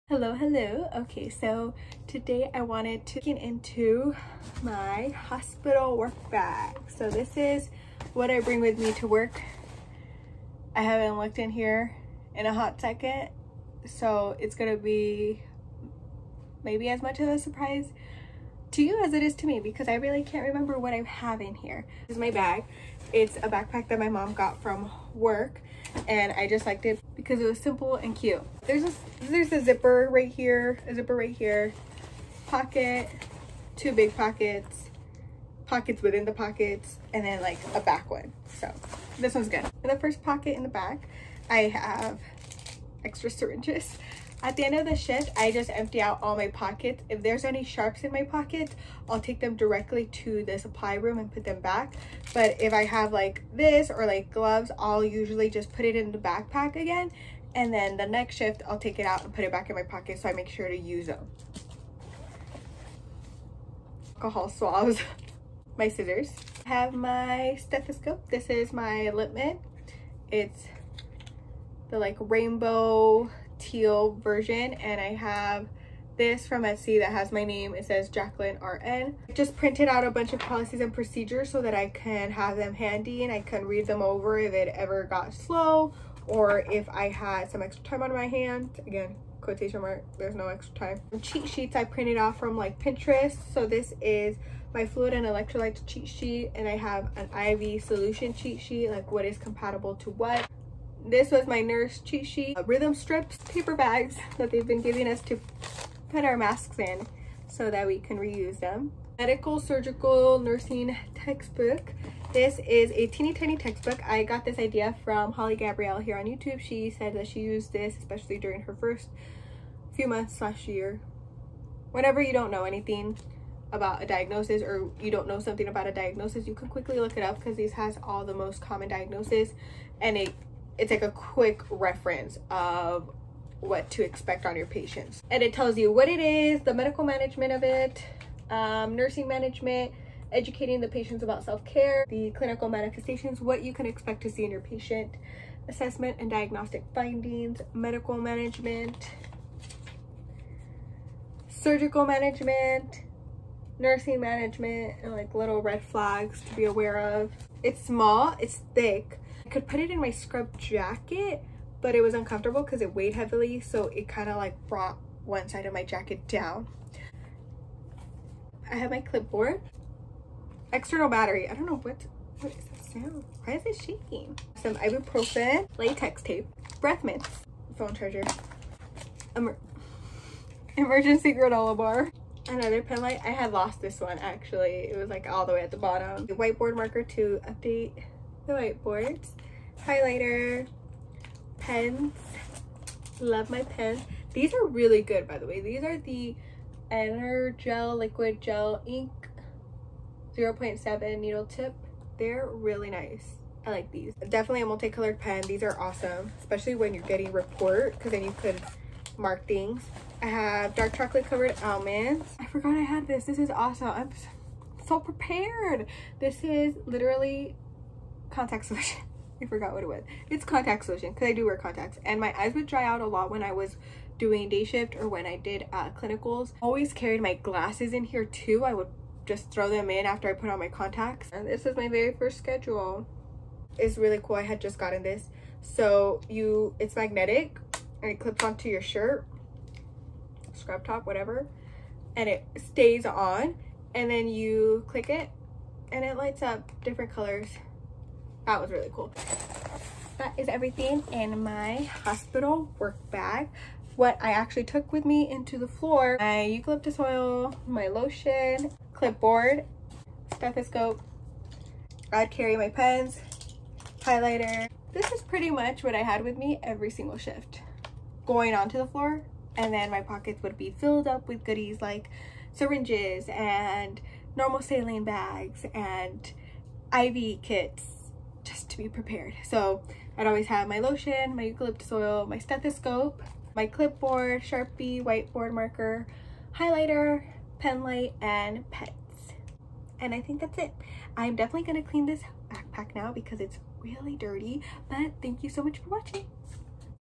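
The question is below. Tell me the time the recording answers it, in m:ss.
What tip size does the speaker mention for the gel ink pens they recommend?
3:20.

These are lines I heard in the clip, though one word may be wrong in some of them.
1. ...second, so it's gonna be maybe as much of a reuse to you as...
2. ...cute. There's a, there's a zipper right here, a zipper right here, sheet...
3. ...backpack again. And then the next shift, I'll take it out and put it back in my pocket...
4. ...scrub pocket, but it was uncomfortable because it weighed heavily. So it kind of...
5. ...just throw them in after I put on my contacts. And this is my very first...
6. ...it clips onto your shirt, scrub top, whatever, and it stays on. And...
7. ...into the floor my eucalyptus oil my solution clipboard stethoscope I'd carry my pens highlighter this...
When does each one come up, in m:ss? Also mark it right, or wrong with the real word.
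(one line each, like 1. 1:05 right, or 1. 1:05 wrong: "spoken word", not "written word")
1. 0:12 wrong: "surprise", not "reuse"
2. 0:28 wrong: "pocket", not "sheet"
3. 0:56 right
4. 2:40 wrong: "jacket", not "pocket"
5. 3:49 right
6. 3:58 right
7. 4:15 wrong: "lotion", not "solution".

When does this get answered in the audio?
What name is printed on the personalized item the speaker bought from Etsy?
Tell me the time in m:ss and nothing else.
1:18.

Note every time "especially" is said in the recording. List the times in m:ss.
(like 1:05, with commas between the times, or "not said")
1:57, 3:26.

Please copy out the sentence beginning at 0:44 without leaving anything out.
At the end of the shift, I just empty out all my pockets.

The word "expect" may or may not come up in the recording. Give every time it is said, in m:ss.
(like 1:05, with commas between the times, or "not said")
2:14, 2:23.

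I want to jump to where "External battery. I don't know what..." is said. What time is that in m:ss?
2:50.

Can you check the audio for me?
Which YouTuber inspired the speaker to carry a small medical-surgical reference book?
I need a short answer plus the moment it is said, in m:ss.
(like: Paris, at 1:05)
Holly Gabrielle, at 1:55.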